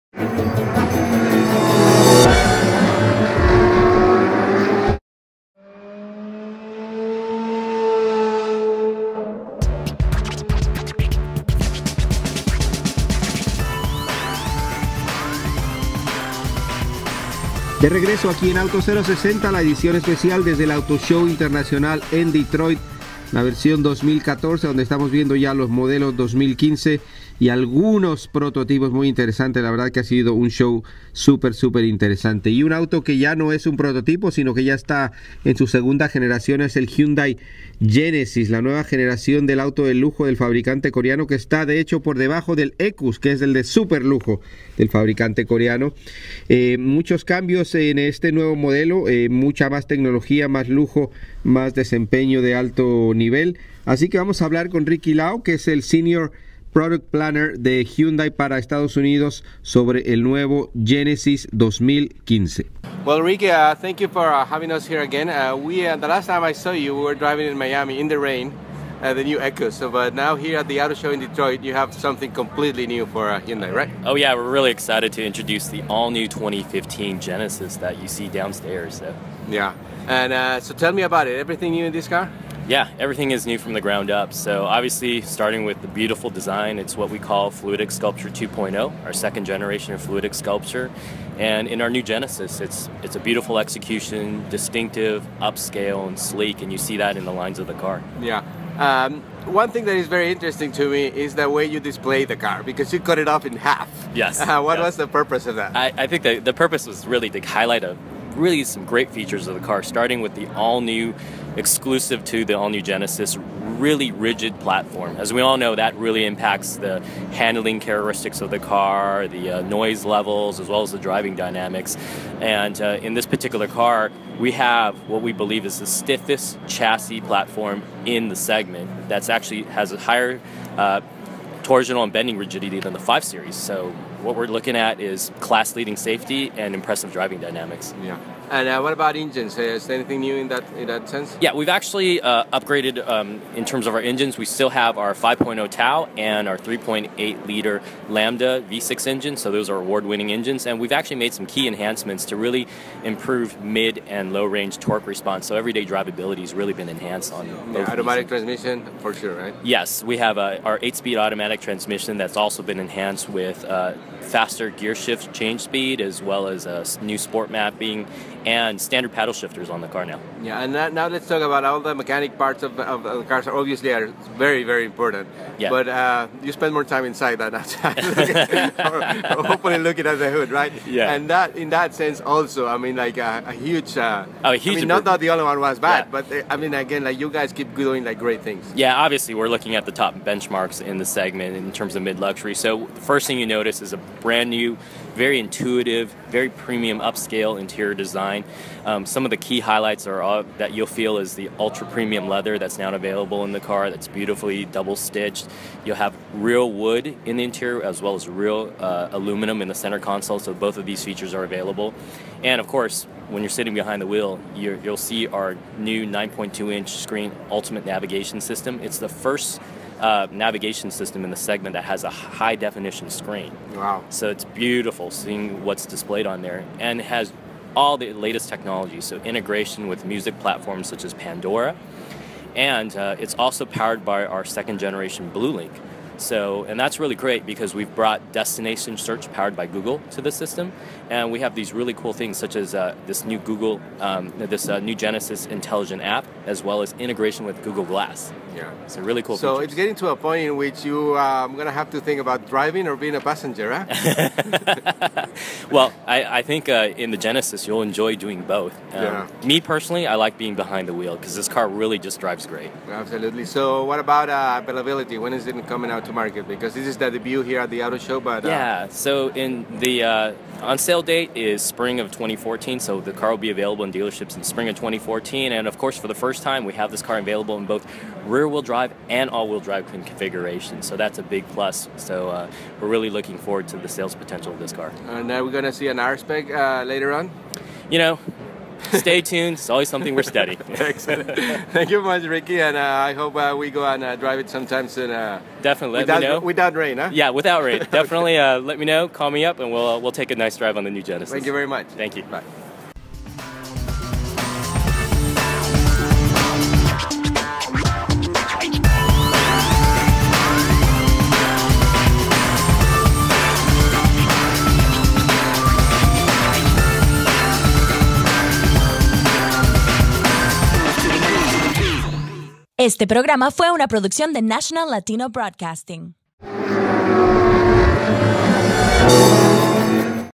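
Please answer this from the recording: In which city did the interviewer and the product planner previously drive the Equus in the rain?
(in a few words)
Miami.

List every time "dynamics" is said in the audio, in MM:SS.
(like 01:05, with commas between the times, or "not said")
02:01, 02:17.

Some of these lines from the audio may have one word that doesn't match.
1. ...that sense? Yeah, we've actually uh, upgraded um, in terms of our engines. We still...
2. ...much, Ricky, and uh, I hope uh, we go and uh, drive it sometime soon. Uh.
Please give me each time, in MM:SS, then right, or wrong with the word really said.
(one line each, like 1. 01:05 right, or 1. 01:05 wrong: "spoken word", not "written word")
1. 02:20 right
2. 04:52 right.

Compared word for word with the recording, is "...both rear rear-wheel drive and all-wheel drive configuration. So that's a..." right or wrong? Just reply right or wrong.
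right.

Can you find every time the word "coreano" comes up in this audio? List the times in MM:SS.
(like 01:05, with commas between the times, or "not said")
00:40, 00:45.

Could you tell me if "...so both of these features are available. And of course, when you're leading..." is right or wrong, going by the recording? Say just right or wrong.
wrong.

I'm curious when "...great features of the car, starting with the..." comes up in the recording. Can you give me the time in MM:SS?
01:48.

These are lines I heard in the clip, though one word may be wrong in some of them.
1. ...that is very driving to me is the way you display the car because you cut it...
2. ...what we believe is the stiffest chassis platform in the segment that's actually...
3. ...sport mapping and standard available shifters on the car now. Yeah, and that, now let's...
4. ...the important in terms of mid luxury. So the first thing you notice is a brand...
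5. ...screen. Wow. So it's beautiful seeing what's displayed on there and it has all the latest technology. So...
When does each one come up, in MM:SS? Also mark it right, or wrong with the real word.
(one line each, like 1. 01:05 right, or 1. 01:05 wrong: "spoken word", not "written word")
1. 01:39 wrong: "interesting", not "driving"
2. 02:05 right
3. 02:47 wrong: "paddle", not "available"
4. 03:10 wrong: "segment", not "important"
5. 03:43 right.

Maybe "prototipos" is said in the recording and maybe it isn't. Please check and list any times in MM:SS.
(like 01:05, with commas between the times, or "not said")
00:28, 00:33.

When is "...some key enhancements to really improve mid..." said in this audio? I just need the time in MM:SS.
02:31.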